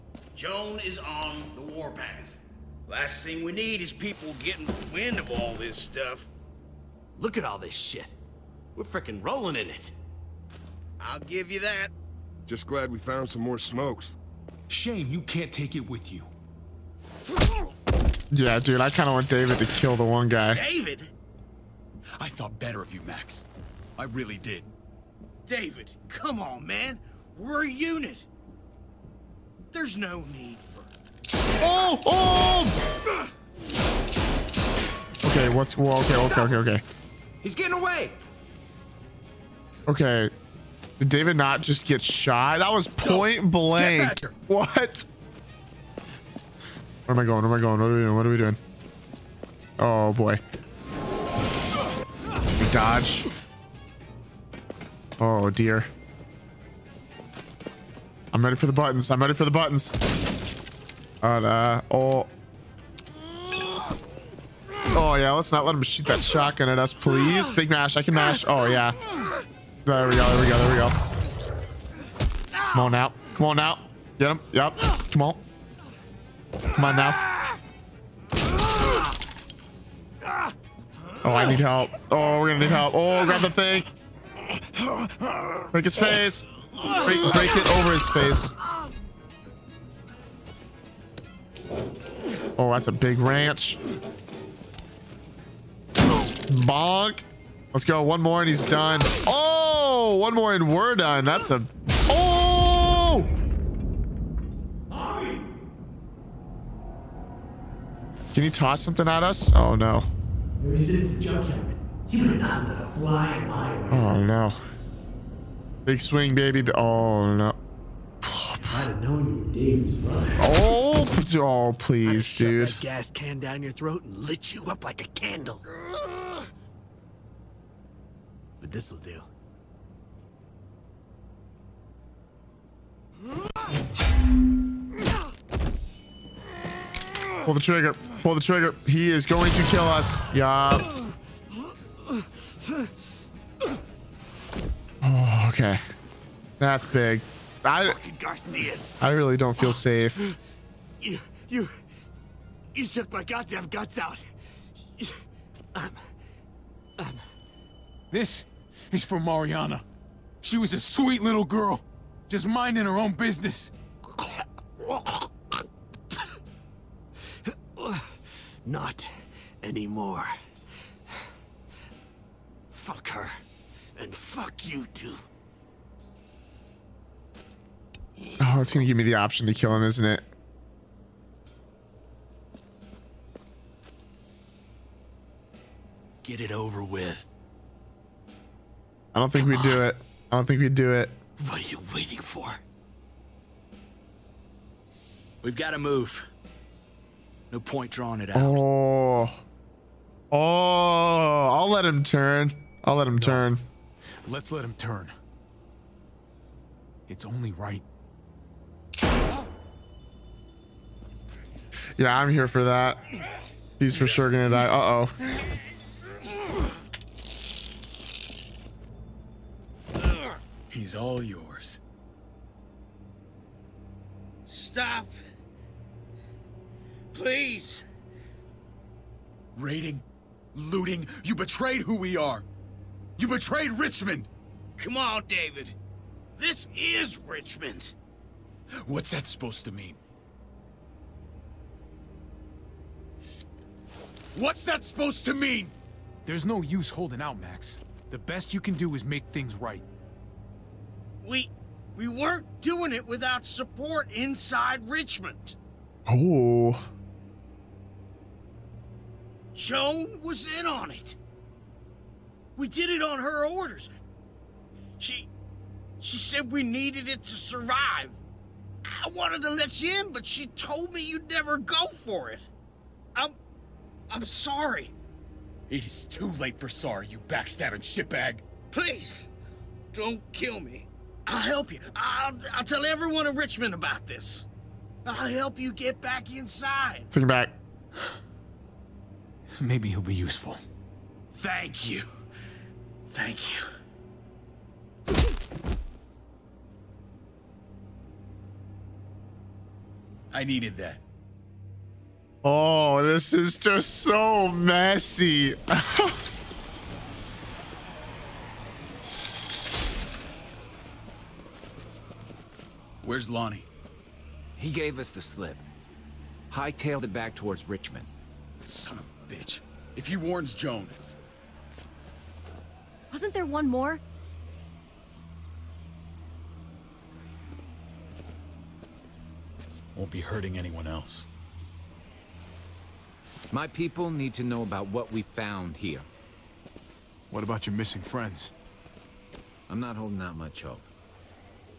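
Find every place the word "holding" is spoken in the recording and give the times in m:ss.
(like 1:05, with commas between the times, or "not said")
4:06, 5:39.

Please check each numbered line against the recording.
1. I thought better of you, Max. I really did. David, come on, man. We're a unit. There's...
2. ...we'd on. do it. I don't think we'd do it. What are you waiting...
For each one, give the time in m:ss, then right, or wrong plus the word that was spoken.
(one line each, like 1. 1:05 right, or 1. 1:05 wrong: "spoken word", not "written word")
1. 0:22 right
2. 3:09 right.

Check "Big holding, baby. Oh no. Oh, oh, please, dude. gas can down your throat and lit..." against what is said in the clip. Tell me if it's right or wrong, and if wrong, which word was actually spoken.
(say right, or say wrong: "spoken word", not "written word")
wrong: "swing", not "holding".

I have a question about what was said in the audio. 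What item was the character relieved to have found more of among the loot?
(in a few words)
Smokes.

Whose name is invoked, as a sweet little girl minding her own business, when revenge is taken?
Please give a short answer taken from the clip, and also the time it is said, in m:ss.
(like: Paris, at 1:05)
Mariana, at 2:39.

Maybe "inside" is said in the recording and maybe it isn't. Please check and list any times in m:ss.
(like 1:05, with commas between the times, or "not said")
4:14, 4:46.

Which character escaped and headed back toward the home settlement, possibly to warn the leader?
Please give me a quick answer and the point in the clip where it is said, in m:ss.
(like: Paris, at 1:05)
Lonnie, at 5:13.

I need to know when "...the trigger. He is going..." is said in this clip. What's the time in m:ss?
2:18.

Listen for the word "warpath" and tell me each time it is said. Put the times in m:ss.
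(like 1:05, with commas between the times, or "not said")
0:01.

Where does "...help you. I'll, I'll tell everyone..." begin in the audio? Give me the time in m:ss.
4:41.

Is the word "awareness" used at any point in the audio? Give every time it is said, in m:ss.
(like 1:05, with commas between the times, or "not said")
not said.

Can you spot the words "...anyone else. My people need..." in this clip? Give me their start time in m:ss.
5:30.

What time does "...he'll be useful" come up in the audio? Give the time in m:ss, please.
4:49.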